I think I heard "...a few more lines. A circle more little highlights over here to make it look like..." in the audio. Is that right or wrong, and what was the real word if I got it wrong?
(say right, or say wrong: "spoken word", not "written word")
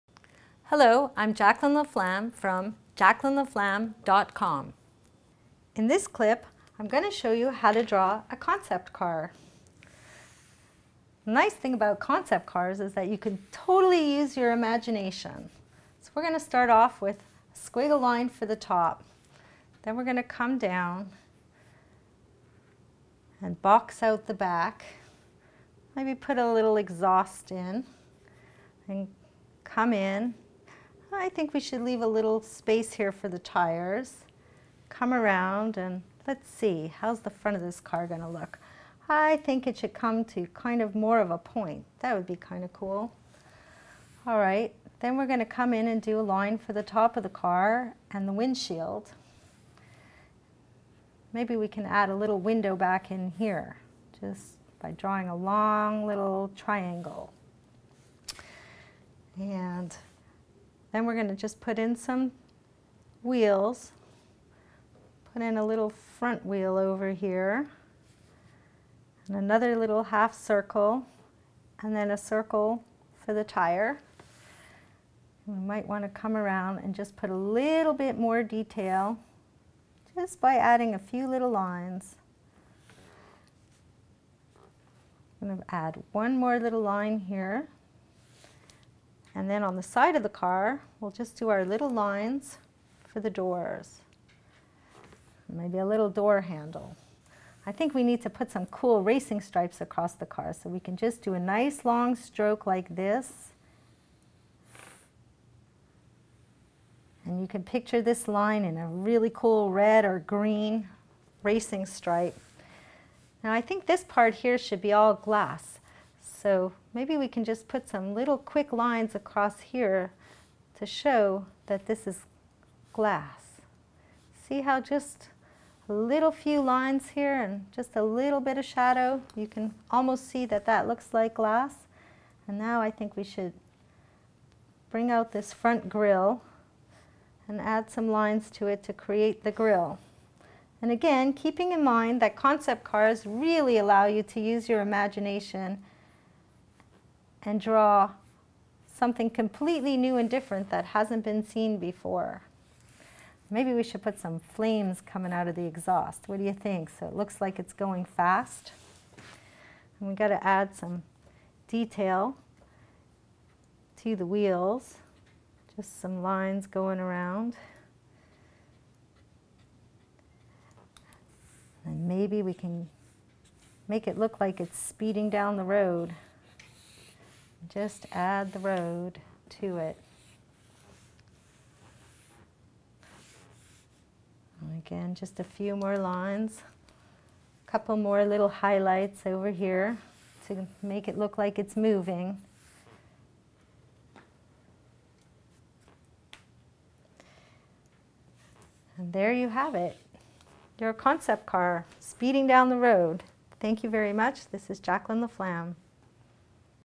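wrong: "couple", not "circle".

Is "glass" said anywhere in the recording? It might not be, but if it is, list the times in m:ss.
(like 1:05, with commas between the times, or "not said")
1:55, 2:02, 2:11.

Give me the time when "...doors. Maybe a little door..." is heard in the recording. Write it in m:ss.
1:33.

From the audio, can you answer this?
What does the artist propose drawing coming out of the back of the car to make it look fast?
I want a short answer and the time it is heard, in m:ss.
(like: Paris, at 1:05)
flames, at 2:34.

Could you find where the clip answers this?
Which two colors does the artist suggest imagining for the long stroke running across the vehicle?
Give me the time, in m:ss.
1:49.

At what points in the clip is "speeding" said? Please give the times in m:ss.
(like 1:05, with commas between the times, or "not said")
2:54, 3:21.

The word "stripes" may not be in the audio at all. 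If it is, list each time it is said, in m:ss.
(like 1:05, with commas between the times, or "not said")
1:39, 1:51.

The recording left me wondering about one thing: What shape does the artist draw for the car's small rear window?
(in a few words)
long little triangle.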